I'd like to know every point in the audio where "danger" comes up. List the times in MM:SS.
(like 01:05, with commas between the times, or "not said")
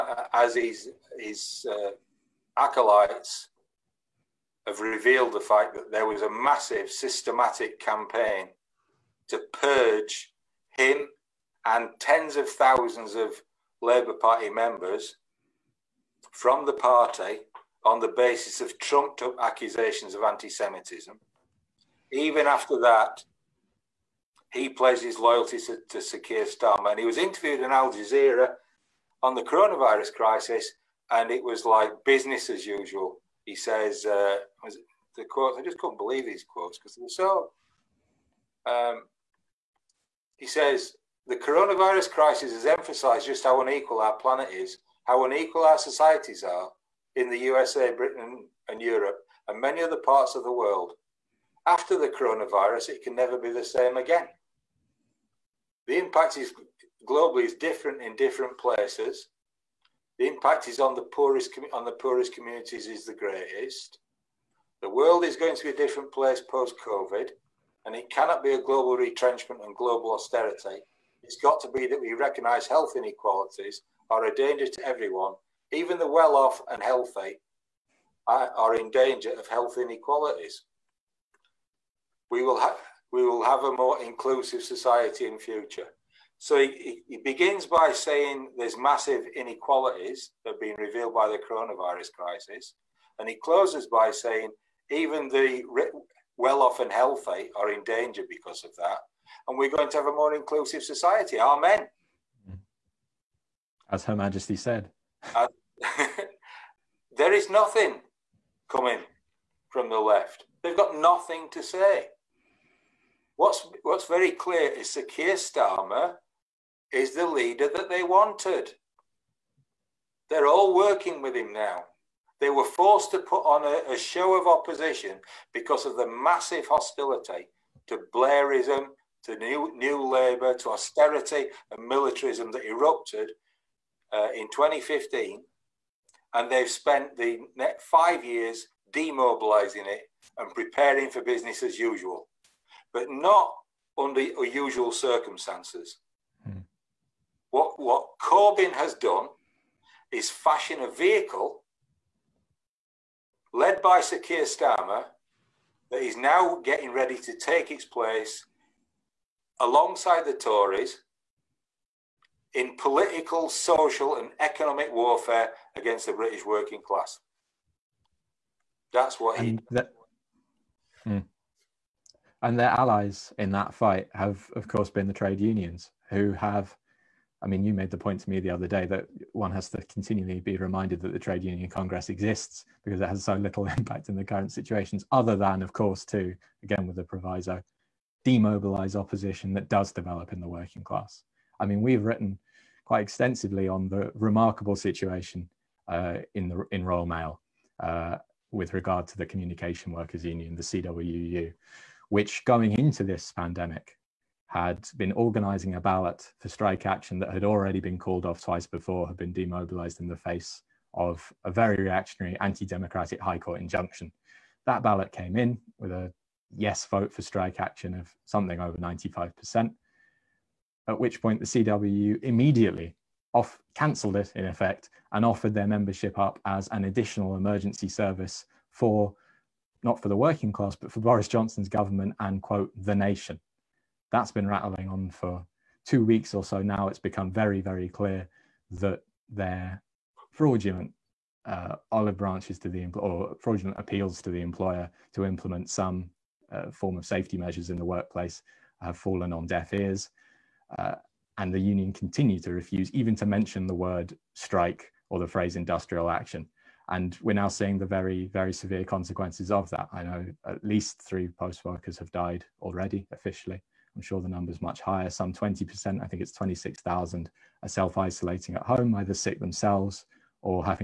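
01:14, 01:18, 01:37.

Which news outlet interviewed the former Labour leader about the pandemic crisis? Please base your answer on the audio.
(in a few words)
Al Jazeera.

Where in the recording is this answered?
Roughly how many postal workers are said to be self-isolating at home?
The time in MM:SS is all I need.
04:26.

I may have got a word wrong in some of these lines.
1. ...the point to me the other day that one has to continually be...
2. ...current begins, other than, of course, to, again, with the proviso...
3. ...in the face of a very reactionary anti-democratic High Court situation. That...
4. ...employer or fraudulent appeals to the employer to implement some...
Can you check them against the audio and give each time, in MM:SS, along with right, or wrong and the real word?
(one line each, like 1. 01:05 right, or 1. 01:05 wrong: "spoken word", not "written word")
1. 02:57 right
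2. 03:04 wrong: "situations", not "begins"
3. 03:29 wrong: "injunction", not "situation"
4. 04:02 right.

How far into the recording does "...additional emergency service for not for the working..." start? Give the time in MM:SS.
03:46.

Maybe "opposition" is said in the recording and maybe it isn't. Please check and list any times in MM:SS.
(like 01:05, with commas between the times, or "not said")
02:04, 03:08.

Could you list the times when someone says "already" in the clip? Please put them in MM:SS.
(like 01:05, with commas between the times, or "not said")
03:27, 04:22.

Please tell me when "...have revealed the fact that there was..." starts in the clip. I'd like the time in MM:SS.
00:04.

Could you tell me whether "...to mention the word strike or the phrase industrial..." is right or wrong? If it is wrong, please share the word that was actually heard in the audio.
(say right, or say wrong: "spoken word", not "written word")
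right.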